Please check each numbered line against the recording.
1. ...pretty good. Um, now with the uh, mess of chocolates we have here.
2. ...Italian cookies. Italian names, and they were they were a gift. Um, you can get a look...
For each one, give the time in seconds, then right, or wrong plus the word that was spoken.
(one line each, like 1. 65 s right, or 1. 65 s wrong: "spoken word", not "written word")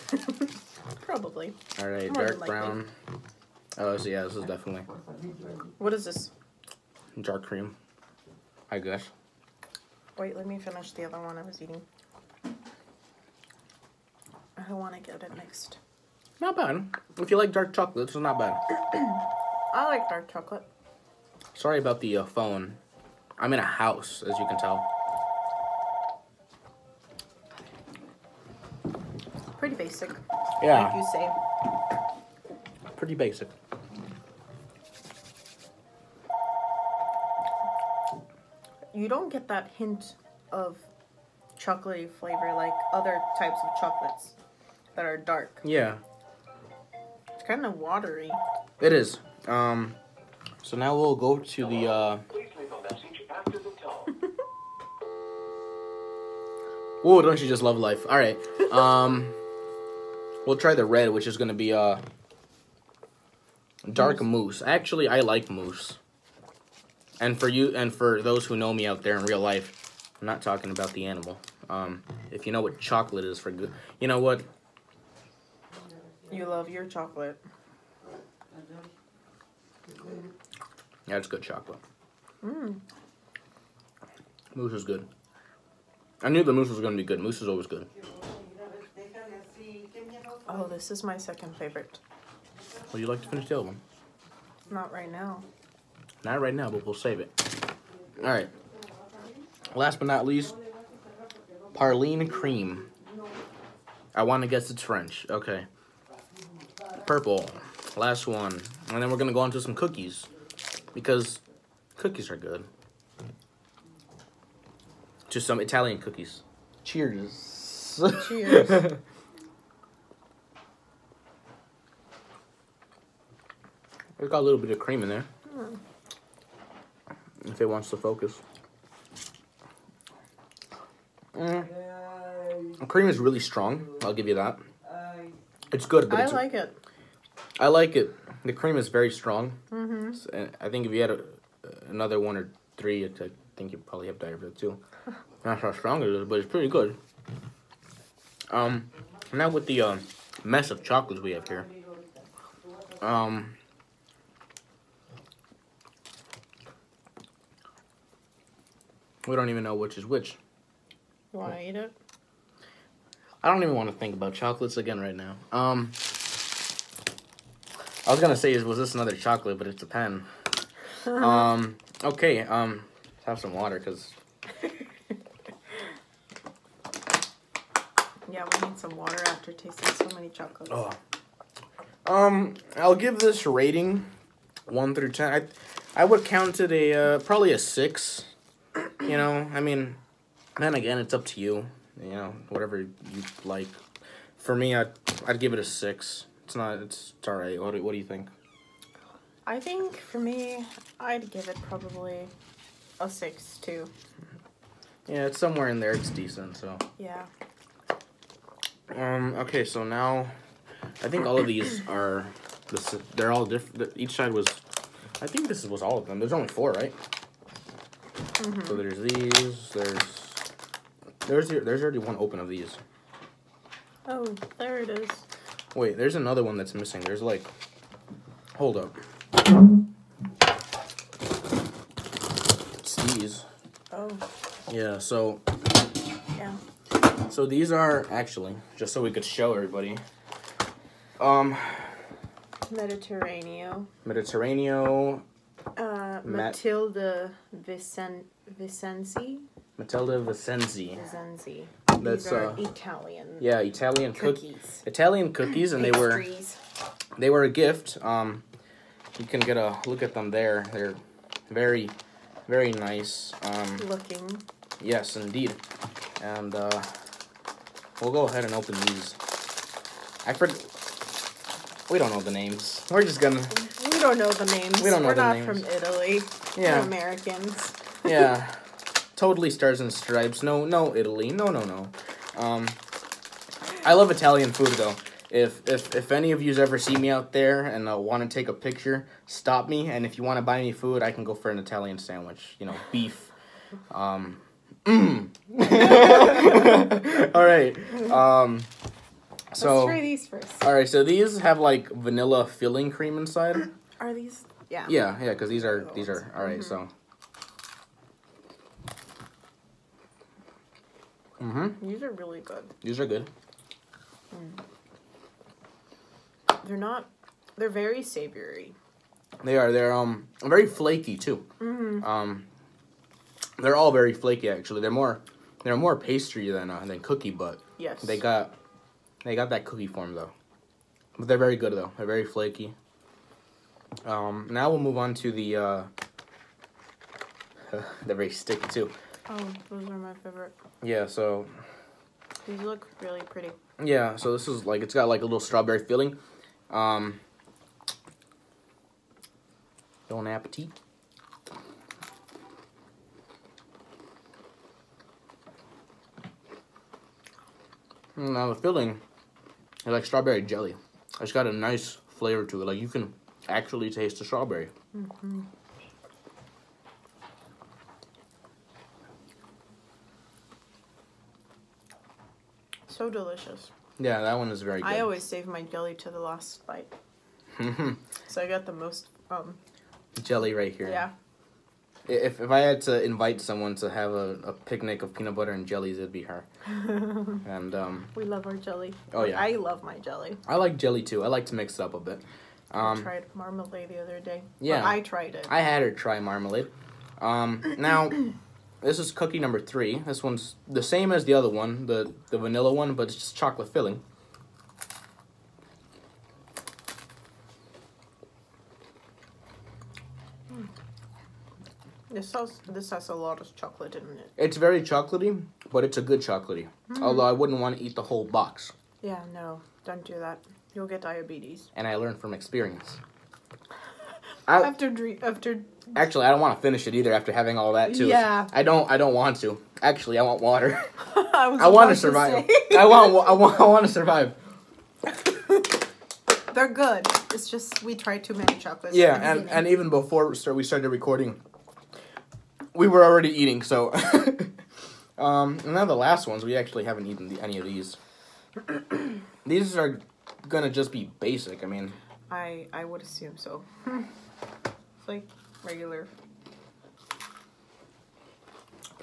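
1. 146 s right
2. 253 s wrong: "cookies", not "names".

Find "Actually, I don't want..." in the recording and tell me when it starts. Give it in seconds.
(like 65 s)
425 s.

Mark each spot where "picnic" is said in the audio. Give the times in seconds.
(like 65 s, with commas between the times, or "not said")
384 s.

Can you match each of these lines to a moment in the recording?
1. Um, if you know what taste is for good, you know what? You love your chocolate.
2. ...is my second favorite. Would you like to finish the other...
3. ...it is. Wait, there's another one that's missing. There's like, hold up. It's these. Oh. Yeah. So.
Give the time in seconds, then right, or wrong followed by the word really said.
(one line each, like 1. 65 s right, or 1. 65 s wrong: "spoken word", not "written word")
1. 71 s wrong: "chocolate", not "taste"
2. 90 s right
3. 224 s right.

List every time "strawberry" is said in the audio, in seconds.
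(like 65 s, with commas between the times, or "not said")
345 s, 360 s, 364 s.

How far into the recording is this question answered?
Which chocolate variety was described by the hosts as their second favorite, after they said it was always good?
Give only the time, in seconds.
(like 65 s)
63 s.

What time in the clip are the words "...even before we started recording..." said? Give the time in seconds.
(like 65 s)
439 s.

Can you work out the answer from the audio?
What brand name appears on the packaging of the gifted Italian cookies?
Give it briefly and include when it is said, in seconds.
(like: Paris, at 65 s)
Matilda Vicenzi, at 249 s.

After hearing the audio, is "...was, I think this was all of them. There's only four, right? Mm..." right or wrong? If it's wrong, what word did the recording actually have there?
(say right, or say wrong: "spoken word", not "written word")
right.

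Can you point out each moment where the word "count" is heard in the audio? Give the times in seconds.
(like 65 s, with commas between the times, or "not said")
186 s.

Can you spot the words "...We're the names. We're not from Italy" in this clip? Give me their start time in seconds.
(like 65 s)
275 s.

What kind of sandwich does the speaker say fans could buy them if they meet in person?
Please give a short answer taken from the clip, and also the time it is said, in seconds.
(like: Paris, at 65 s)
Italian sandwich, at 291 s.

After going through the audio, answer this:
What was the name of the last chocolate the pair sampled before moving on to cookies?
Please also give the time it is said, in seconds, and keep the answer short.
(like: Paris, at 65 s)
Parline Cream, at 101 s.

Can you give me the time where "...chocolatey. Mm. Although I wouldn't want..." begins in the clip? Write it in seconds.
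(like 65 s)
416 s.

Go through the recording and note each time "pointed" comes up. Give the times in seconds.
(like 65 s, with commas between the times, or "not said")
not said.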